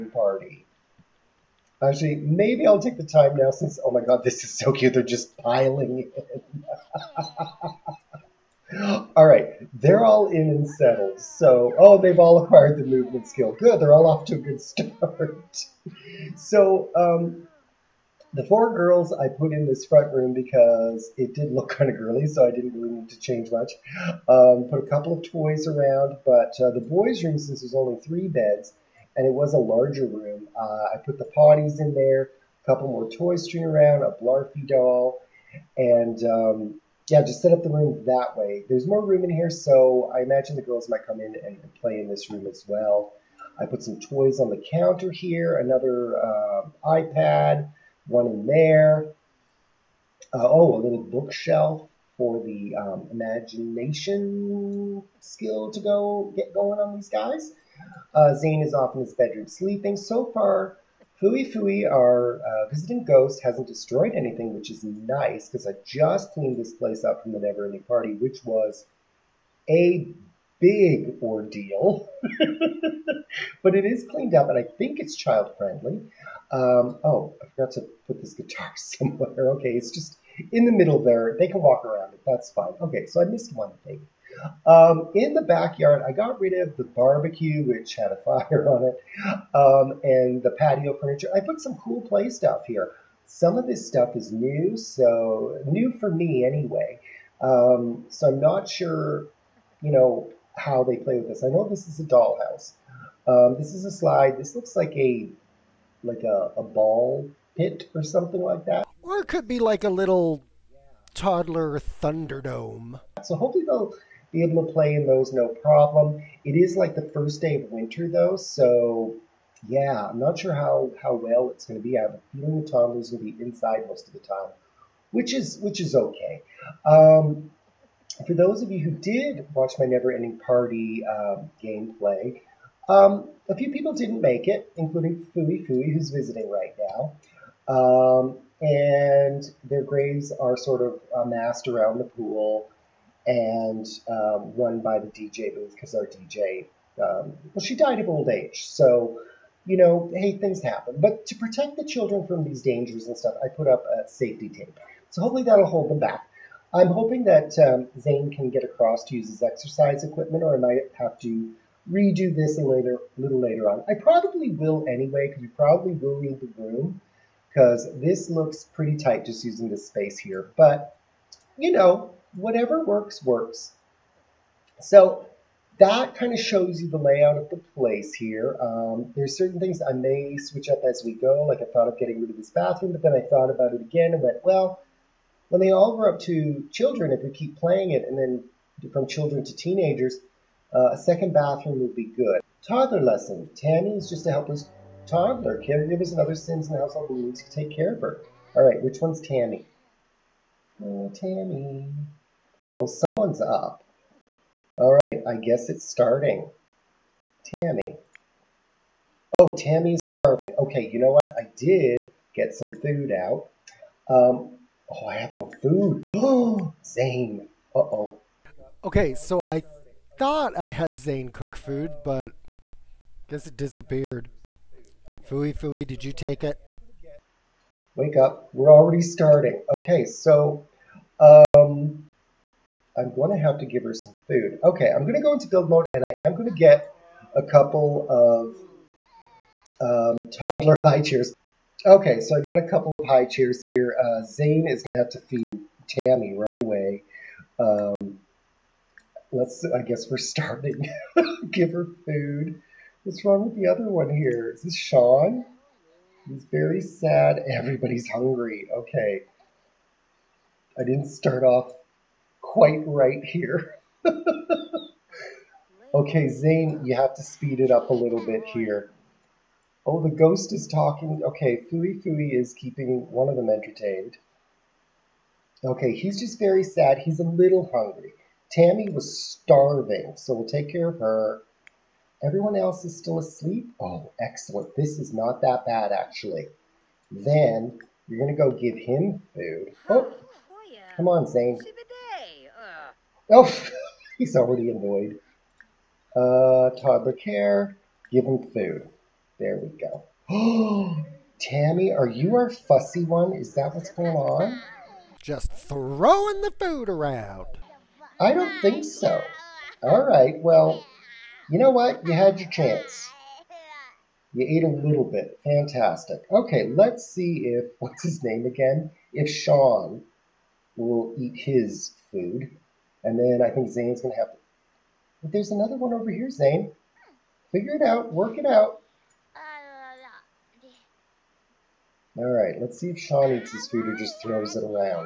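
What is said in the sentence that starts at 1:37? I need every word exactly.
Um, so I'm not sure, you know, how they play with this.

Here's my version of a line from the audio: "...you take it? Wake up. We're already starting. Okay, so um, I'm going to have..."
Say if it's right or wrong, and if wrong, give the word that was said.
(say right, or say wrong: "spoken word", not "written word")
right.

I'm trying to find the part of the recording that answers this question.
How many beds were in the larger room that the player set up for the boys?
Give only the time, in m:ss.
0:28.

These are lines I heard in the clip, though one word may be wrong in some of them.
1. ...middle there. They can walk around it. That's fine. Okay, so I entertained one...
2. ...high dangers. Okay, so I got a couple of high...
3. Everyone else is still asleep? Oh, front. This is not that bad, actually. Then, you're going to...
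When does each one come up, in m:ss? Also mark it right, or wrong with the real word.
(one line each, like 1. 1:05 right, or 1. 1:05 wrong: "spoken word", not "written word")
1. 1:20 wrong: "missed", not "entertained"
2. 4:00 wrong: "chairs", not "dangers"
3. 4:42 wrong: "excellent", not "front".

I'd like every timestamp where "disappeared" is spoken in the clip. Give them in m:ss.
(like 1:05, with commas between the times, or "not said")
3:43.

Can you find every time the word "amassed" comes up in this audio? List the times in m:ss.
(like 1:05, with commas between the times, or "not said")
2:21.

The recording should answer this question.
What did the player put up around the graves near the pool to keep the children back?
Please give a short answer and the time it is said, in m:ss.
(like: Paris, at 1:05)
Safety tape, at 2:34.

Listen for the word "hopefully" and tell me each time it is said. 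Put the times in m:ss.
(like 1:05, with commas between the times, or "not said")
1:53, 2:35.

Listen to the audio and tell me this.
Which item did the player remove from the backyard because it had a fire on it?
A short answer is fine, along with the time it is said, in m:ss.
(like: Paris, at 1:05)
Barbecue, at 1:26.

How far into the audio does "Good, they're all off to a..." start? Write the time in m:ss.
0:13.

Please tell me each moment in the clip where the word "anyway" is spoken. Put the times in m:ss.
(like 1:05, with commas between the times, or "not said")
1:36, 2:44.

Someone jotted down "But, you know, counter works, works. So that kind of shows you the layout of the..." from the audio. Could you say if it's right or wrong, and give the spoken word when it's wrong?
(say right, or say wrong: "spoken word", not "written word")
wrong: "whatever", not "counter".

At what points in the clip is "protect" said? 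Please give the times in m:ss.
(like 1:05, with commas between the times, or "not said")
2:31.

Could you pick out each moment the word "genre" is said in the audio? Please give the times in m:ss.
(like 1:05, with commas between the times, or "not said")
not said.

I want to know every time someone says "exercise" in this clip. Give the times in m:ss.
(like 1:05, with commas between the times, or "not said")
2:39.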